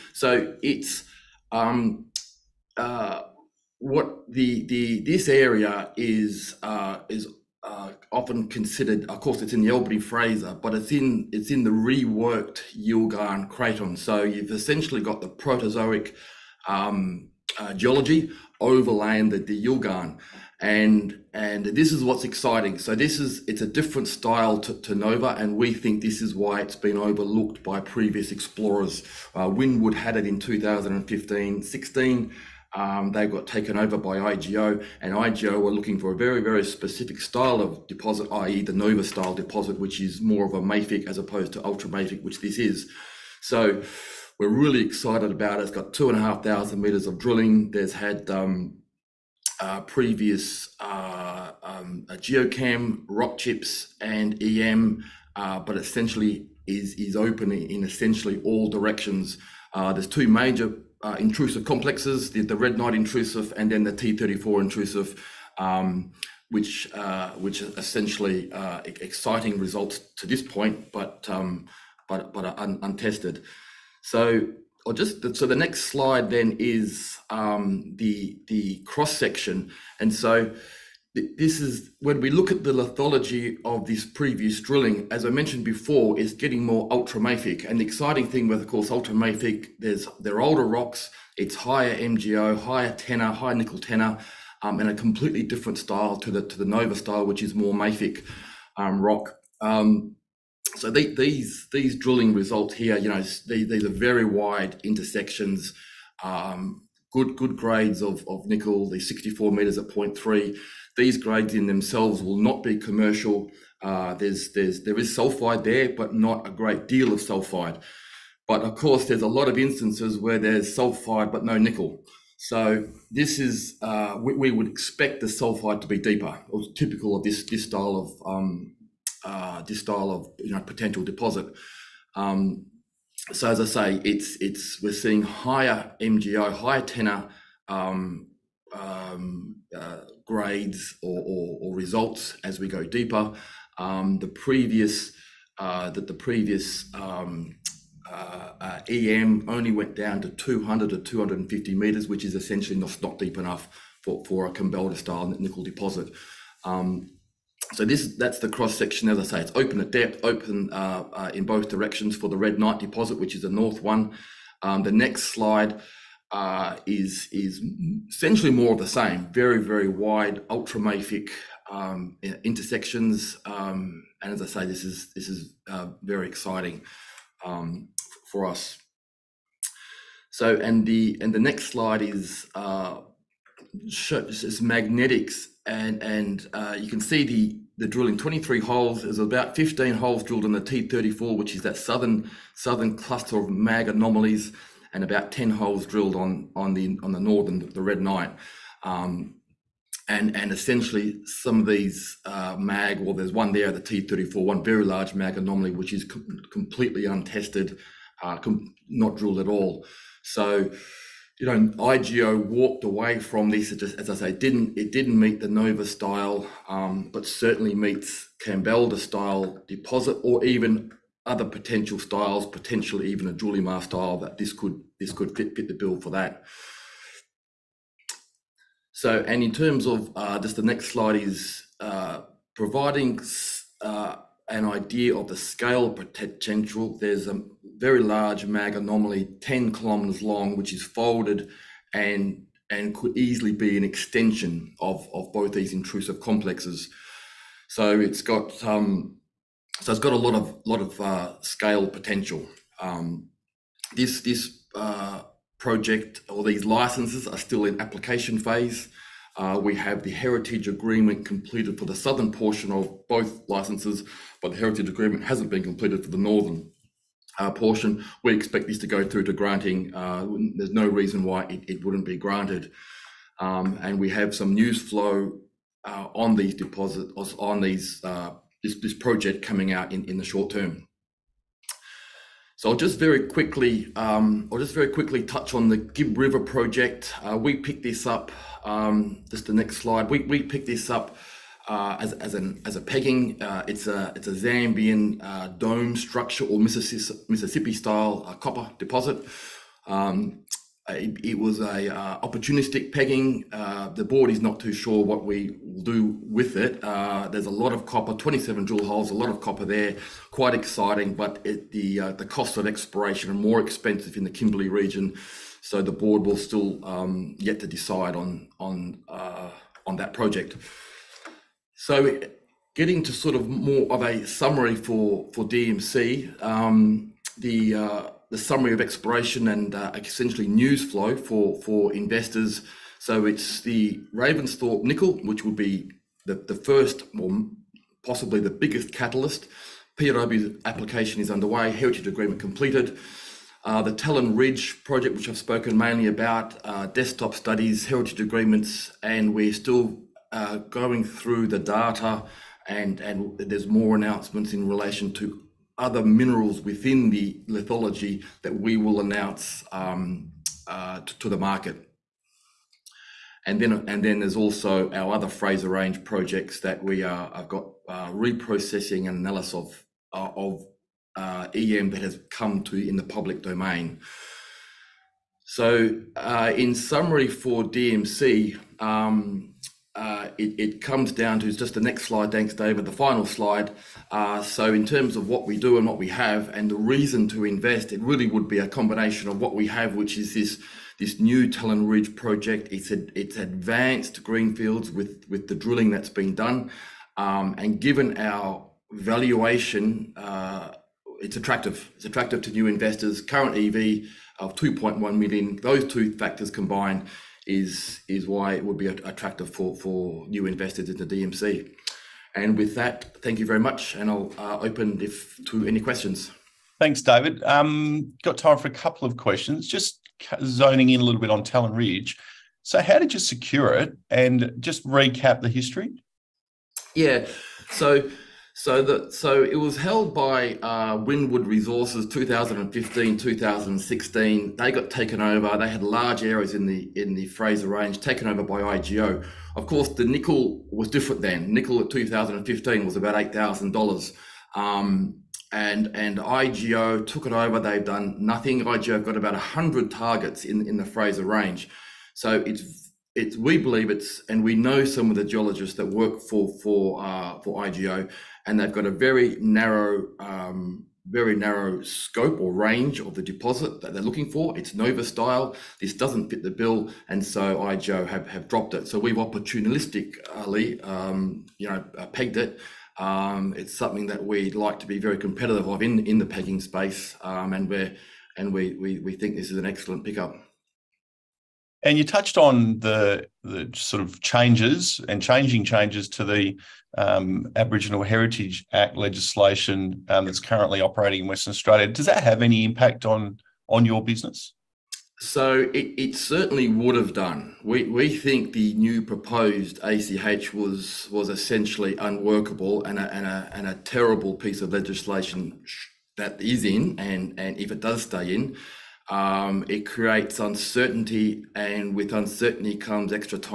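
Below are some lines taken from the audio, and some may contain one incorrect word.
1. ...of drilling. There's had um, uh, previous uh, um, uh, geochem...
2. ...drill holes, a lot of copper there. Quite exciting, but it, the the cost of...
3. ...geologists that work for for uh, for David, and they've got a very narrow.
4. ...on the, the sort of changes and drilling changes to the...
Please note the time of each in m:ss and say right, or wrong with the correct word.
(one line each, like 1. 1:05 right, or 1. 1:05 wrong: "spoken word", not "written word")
1. 0:47 right
2. 5:08 right
3. 7:35 wrong: "IGO", not "David"
4. 8:02 wrong: "changing", not "drilling".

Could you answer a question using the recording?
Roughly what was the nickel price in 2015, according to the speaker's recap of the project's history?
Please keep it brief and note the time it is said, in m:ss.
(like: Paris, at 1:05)
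8,000 dollars, at 7:23.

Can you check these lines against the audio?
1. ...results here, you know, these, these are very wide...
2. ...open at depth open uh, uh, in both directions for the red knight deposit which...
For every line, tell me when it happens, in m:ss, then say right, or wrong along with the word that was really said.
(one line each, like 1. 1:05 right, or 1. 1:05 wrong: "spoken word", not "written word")
1. 1:42 right
2. 2:39 right.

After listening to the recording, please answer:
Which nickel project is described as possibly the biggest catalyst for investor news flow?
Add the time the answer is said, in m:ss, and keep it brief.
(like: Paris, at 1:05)
Ravensthorpe, at 5:34.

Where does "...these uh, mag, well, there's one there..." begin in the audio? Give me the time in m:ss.
3:21.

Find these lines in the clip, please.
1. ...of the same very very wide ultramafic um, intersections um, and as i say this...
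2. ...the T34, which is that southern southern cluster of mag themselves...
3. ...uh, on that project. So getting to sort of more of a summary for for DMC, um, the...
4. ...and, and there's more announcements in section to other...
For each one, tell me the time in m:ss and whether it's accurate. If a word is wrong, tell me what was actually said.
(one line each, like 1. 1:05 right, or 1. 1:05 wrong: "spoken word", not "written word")
1. 2:48 right
2. 3:10 wrong: "anomalies", not "themselves"
3. 5:19 right
4. 5:52 wrong: "relation", not "section".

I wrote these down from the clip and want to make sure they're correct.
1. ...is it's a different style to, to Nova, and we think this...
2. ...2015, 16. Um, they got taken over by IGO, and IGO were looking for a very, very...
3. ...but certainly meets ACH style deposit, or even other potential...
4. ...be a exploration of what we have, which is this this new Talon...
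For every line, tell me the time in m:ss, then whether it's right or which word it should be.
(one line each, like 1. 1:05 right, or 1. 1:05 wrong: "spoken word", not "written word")
1. 0:23 right
2. 0:30 right
3. 3:37 wrong: "Kambalda", not "ACH"
4. 6:28 wrong: "combination", not "exploration".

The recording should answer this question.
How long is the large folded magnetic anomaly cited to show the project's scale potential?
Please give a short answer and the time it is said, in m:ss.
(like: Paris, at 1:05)
10 kilometers, at 3:59.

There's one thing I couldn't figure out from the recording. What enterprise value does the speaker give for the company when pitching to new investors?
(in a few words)
2.1 million.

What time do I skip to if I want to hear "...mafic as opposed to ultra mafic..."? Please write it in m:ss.
0:40.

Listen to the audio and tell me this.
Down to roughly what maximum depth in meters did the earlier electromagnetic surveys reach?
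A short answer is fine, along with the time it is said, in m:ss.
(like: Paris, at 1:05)
250 meters, at 2:30.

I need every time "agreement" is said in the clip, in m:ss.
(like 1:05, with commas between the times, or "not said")
4:20, 4:24, 5:42, 5:48.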